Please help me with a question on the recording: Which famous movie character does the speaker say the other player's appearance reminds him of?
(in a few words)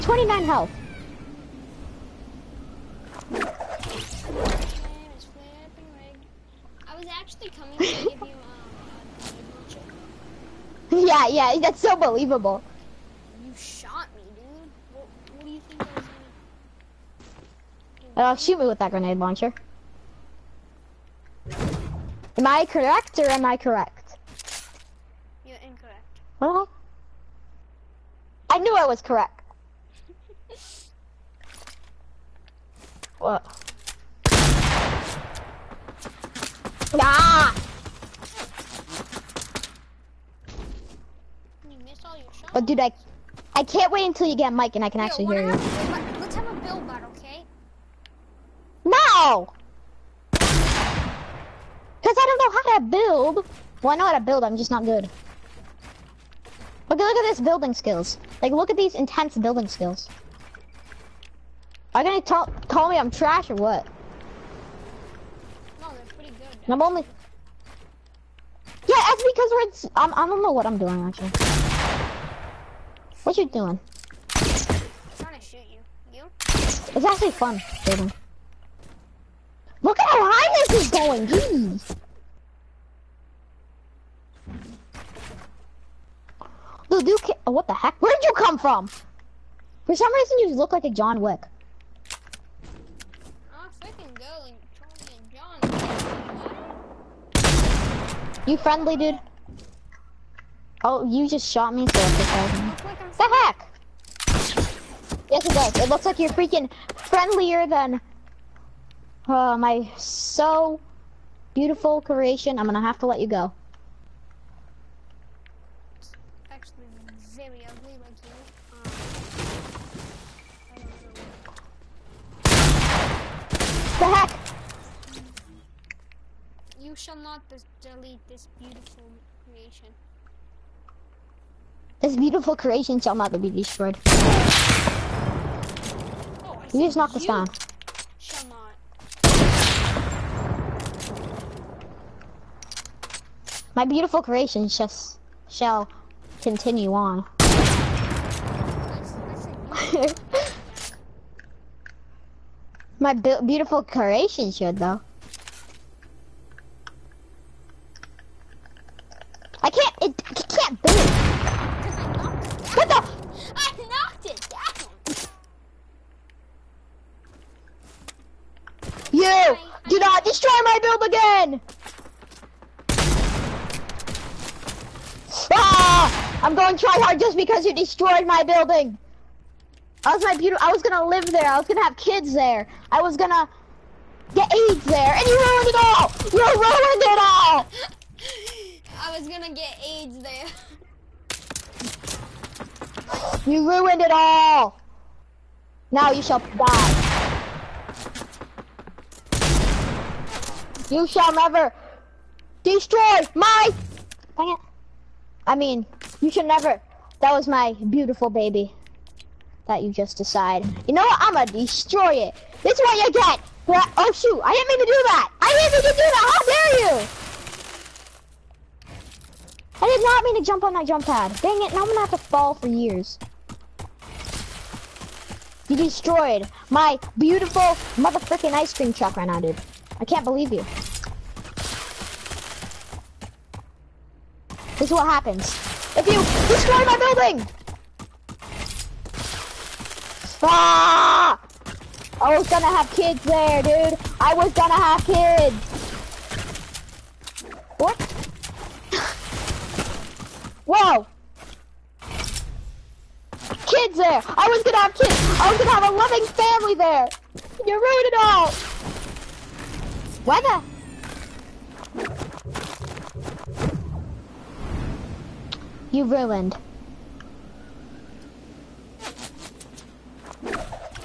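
John Wick.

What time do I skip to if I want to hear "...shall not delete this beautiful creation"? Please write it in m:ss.
2:06.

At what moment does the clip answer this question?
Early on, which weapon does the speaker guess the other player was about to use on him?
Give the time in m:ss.
0:18.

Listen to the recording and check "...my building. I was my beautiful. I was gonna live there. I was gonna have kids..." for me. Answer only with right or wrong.
right.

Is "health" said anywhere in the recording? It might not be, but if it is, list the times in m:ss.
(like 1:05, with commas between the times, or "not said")
0:00.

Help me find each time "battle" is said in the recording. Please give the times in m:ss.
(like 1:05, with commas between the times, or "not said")
0:46.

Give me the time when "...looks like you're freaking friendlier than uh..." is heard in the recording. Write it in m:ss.
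1:45.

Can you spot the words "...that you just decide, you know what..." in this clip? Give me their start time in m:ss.
3:29.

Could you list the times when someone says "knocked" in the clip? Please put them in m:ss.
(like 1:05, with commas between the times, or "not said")
2:16, 2:43.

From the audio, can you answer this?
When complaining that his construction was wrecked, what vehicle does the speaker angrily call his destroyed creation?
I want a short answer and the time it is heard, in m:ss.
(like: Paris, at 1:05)
ice cream truck, at 3:48.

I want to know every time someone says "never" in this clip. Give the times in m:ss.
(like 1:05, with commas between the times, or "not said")
3:21, 3:26.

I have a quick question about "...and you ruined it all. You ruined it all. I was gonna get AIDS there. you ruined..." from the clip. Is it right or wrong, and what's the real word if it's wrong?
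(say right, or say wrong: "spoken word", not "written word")
right.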